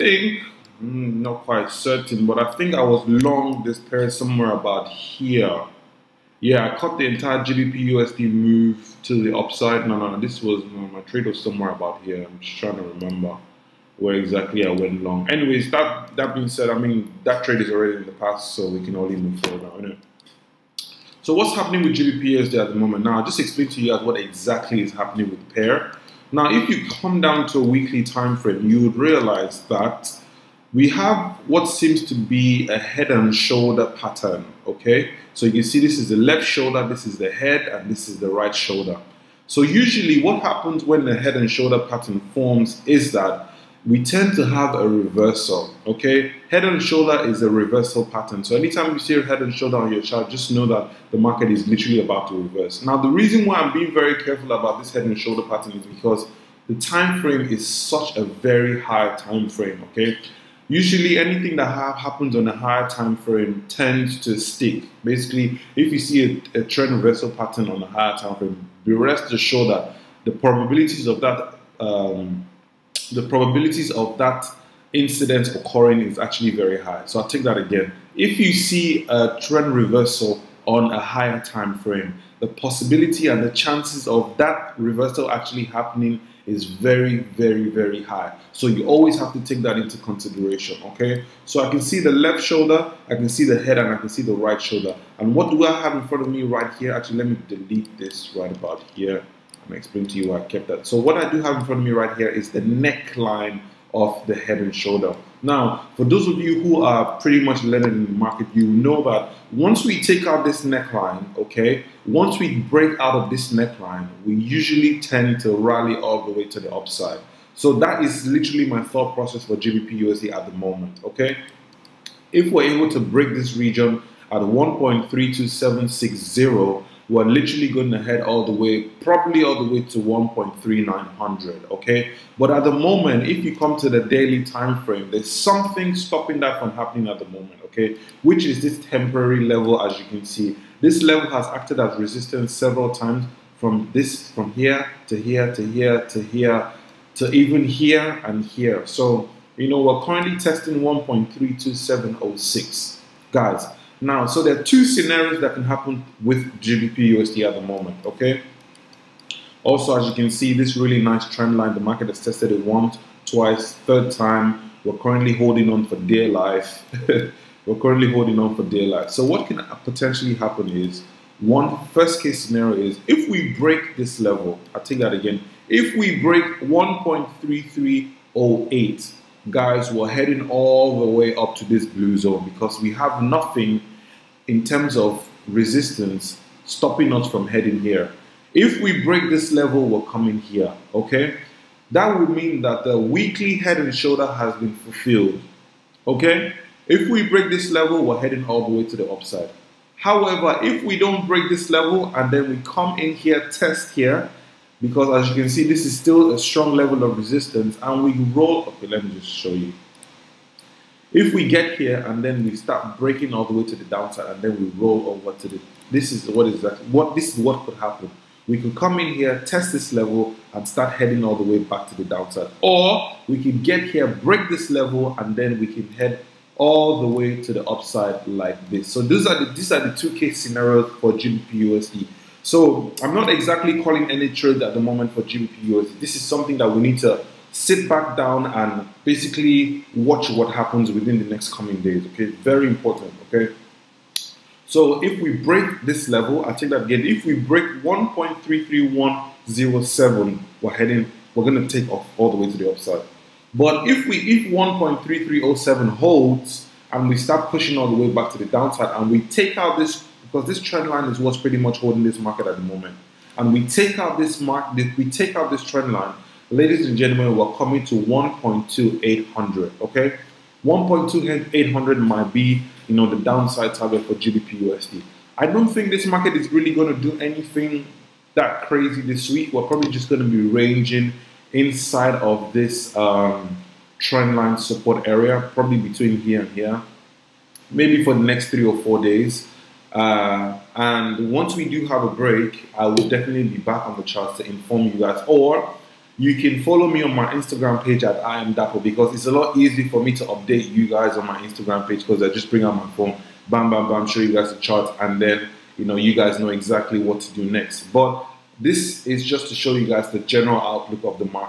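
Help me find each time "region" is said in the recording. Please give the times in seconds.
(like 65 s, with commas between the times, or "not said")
123 s.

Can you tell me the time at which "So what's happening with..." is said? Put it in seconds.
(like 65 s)
21 s.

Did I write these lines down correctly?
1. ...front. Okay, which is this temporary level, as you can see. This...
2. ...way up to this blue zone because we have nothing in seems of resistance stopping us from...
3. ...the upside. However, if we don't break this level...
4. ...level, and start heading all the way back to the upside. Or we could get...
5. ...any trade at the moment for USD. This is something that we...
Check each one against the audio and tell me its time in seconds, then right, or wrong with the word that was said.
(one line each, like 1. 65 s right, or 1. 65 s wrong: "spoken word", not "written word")
1. 137 s wrong: "moment", not "front"
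2. 181 s wrong: "terms", not "seems"
3. 198 s right
4. 219 s wrong: "downside", not "upside"
5. 234 s right.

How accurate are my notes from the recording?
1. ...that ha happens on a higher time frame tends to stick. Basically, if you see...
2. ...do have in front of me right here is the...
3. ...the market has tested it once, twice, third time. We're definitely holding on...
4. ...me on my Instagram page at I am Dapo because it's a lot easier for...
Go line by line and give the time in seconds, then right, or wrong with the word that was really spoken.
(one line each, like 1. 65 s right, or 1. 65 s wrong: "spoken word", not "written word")
1. 61 s right
2. 101 s right
3. 161 s wrong: "currently", not "definitely"
4. 296 s right.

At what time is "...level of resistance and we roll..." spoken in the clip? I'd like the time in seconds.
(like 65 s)
206 s.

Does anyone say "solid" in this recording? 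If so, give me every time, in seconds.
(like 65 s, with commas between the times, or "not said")
not said.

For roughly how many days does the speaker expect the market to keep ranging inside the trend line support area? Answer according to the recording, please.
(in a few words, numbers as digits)
three or four days.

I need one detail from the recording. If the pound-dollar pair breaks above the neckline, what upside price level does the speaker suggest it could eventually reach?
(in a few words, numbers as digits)
1.3900.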